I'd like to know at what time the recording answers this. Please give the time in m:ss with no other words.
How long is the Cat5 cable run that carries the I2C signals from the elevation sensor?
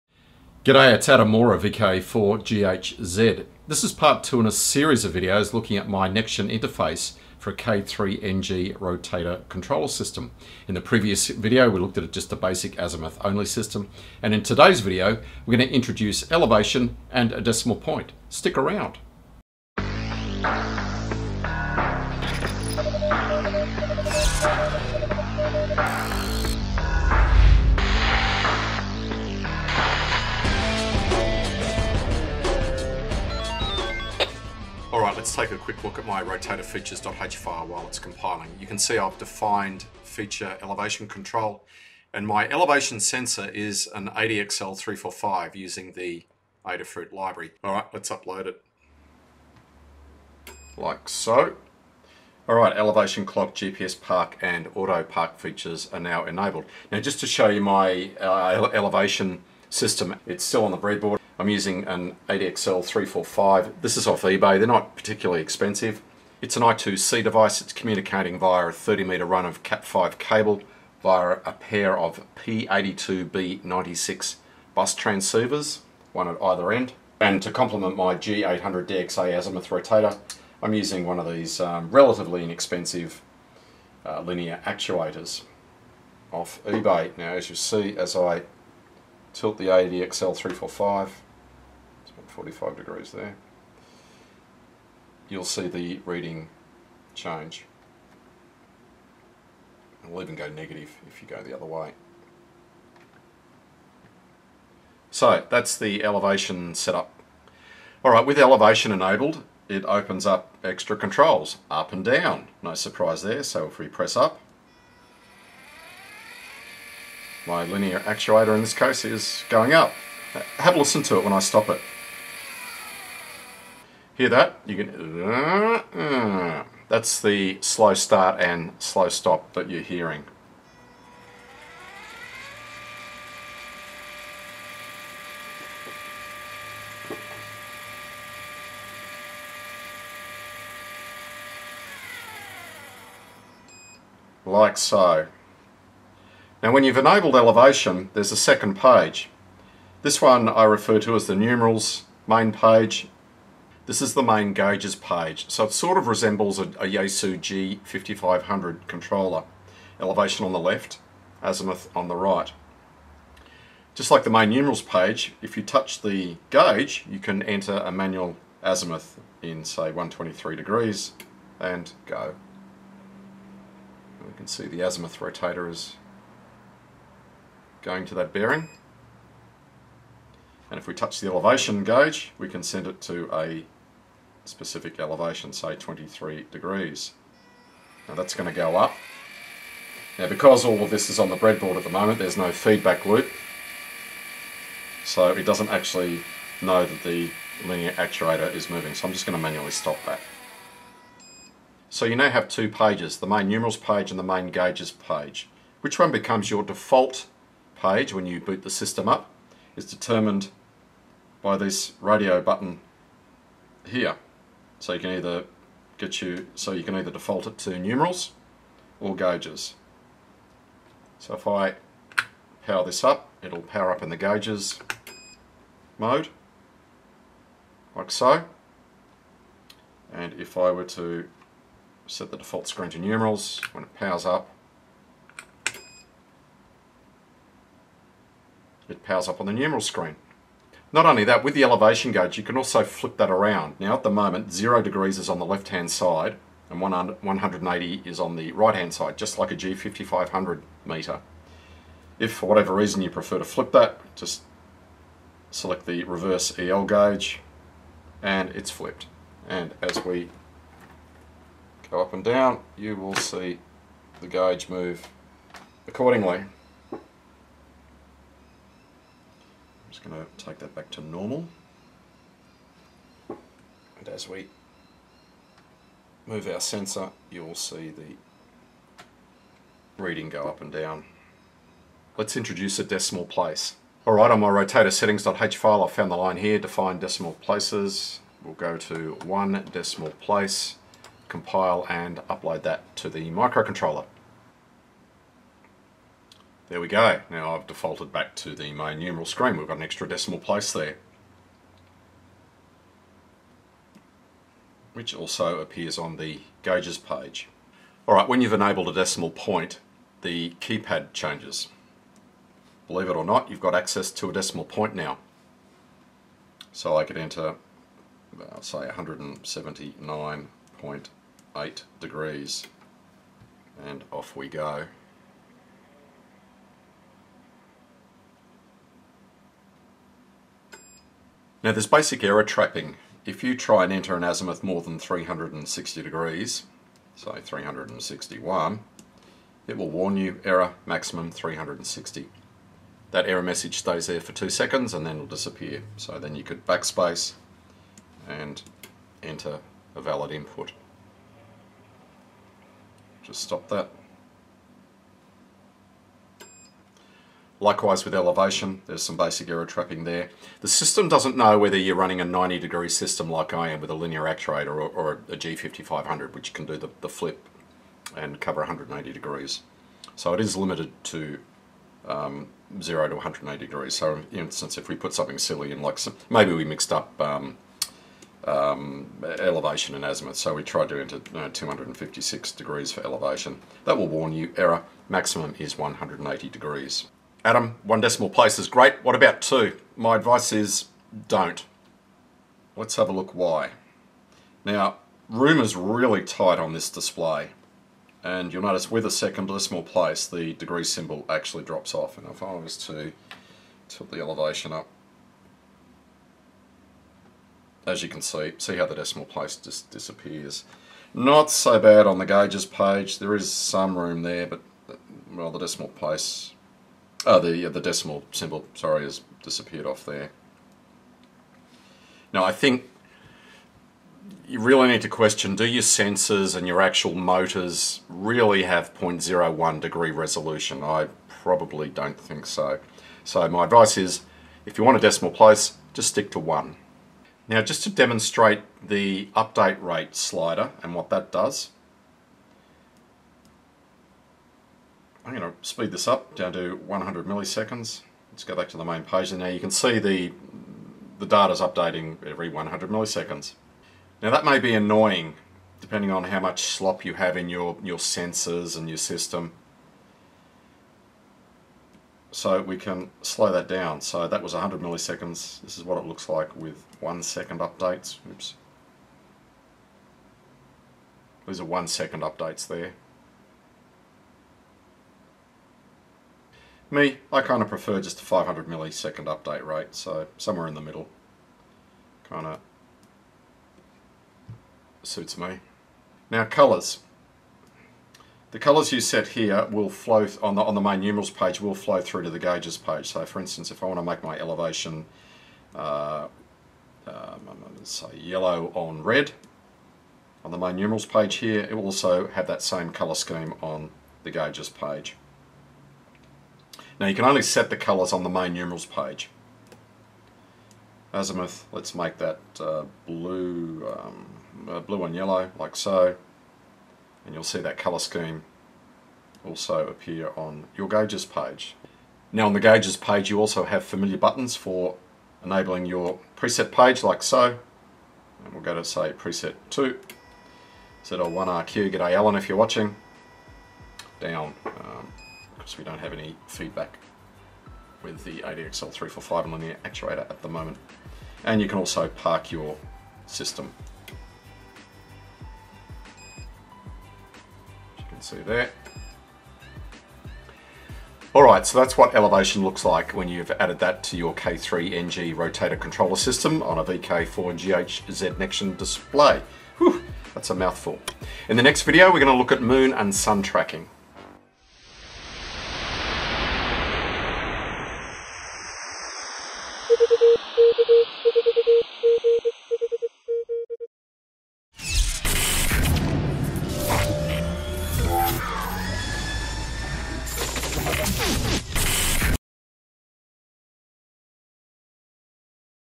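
1:08.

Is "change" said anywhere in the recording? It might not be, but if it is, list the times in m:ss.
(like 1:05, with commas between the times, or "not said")
1:37, 5:11.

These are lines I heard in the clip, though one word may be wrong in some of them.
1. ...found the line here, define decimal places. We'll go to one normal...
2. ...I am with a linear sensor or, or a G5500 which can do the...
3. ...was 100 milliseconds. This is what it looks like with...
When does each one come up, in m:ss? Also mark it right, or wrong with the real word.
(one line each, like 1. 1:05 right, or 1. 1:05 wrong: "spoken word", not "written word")
1. 4:45 wrong: "decimal", not "normal"
2. 6:03 wrong: "actuator", not "sensor"
3. 7:44 right.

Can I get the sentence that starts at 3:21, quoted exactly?
So you now have two pages, the main numerals page and the main gauges page.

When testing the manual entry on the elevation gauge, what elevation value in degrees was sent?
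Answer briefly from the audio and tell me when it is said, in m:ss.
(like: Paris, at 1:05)
23, at 3:05.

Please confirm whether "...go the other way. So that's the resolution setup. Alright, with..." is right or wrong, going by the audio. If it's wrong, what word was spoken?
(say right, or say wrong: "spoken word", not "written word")
wrong: "elevation", not "resolution".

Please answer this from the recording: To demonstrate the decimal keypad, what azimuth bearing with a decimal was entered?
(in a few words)
179.8.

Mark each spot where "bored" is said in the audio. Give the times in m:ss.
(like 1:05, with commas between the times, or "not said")
not said.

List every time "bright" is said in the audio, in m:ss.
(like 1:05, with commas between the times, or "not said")
not said.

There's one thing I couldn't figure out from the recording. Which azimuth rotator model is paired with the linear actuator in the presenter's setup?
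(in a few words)
G800 DXA.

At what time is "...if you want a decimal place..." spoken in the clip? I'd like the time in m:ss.
7:14.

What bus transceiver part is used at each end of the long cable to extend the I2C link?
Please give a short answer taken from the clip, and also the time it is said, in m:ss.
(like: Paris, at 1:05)
P82B96, at 1:12.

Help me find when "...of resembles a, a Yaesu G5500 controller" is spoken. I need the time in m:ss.
2:35.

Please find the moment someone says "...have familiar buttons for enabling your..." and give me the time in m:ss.
8:43.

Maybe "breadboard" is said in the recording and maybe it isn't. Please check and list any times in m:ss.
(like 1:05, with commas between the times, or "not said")
1:00, 3:11.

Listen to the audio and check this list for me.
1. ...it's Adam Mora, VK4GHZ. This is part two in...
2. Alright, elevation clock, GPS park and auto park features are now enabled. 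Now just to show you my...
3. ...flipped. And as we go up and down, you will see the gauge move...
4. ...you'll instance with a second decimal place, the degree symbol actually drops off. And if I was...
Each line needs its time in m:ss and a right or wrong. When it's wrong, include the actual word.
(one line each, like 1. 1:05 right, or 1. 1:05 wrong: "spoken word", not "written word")
1. 0:00 right
2. 0:52 right
3. 4:18 right
4. 6:38 wrong: "notice", not "instance".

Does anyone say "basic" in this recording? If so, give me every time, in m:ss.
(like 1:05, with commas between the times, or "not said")
0:12, 5:31, 5:59.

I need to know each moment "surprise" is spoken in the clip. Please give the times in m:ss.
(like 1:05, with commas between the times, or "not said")
1:52.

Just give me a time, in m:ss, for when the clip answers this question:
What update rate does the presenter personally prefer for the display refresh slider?
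7:58.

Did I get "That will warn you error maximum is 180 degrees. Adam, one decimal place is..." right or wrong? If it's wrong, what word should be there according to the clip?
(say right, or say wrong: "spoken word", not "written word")
right.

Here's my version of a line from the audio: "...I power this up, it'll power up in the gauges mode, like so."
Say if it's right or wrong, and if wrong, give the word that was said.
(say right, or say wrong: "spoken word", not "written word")
right.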